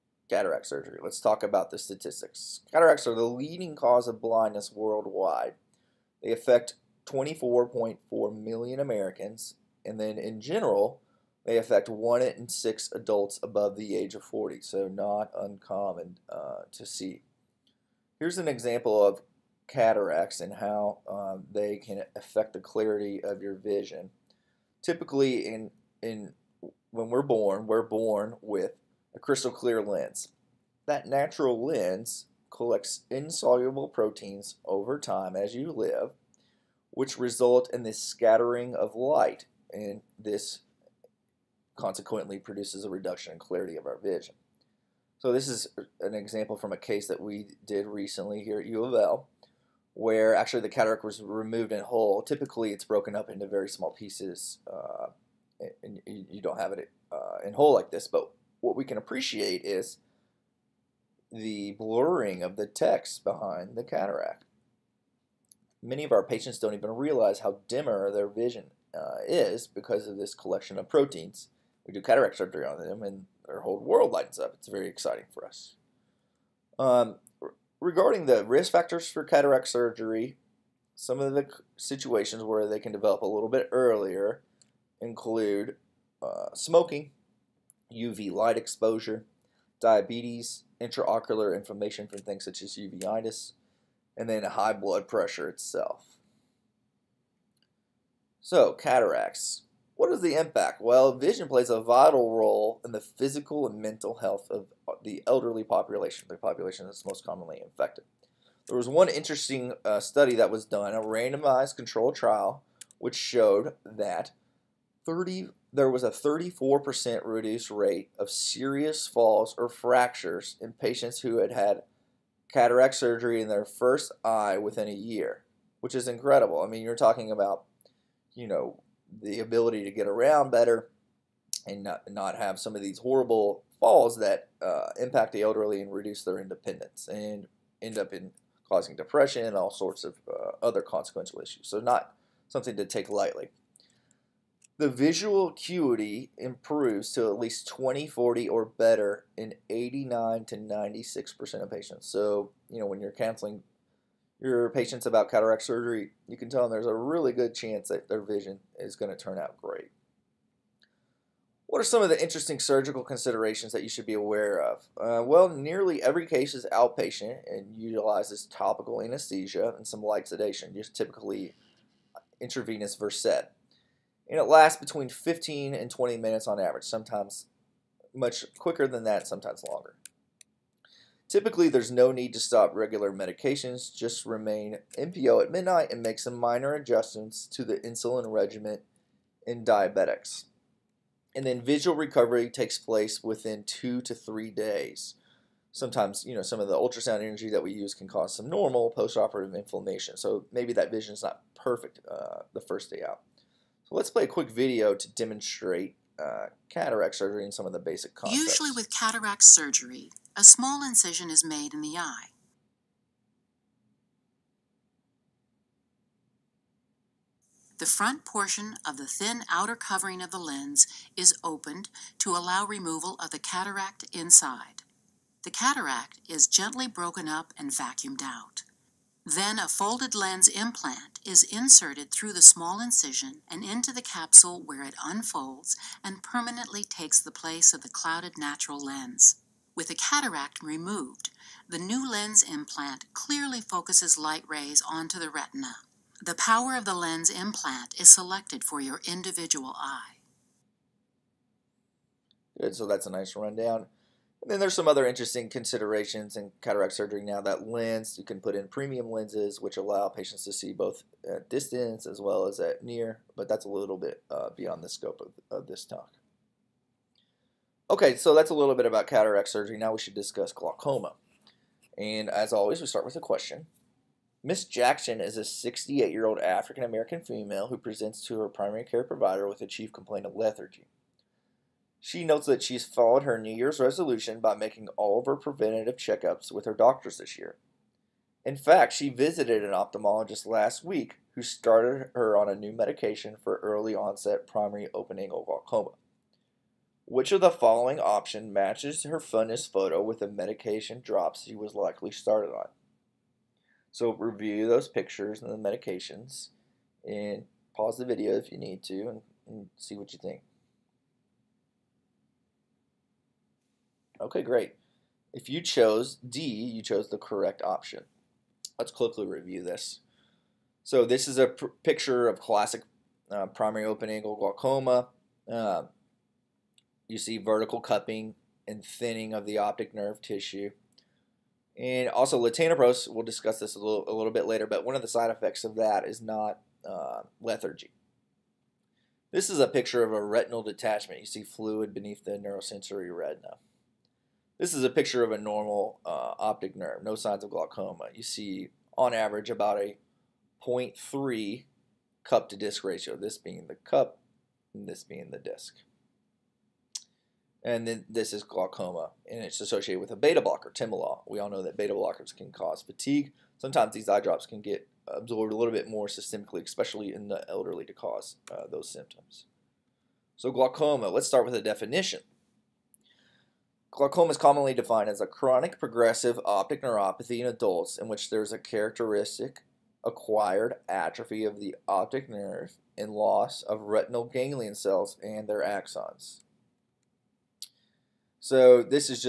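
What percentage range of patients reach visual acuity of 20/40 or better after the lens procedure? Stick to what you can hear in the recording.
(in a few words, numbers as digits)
89 to 96%.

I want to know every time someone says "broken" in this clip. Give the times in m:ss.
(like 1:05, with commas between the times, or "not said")
0:52, 3:46.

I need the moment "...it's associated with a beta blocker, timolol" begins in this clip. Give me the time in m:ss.
5:59.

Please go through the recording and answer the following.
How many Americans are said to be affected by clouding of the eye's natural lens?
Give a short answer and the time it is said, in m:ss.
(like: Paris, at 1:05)
24.4 million, at 0:07.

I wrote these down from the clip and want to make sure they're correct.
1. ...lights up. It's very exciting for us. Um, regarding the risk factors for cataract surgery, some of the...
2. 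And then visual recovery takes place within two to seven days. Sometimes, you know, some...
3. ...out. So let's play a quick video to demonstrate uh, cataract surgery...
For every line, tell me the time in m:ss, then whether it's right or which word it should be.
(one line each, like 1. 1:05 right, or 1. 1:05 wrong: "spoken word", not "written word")
1. 1:14 right
2. 3:11 wrong: "three", not "seven"
3. 3:23 right.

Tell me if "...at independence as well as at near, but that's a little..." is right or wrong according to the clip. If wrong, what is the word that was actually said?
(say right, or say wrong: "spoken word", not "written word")
wrong: "distance", not "independence".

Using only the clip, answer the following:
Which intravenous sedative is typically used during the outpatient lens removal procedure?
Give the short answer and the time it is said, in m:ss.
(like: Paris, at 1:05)
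Versed, at 2:52.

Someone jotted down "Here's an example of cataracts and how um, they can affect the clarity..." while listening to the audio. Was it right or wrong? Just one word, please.
right.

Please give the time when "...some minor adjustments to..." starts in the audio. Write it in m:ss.
3:06.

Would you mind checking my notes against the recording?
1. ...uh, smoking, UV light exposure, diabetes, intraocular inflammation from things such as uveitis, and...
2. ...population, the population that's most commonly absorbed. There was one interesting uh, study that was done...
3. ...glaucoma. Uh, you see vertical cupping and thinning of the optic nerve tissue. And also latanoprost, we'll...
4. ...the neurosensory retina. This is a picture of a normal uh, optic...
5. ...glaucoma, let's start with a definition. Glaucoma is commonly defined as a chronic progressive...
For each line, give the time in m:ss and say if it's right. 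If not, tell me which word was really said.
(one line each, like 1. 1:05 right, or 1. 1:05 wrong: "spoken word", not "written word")
1. 1:26 right
2. 1:45 wrong: "infected", not "absorbed"
3. 5:24 right
4. 5:42 right
5. 6:10 right.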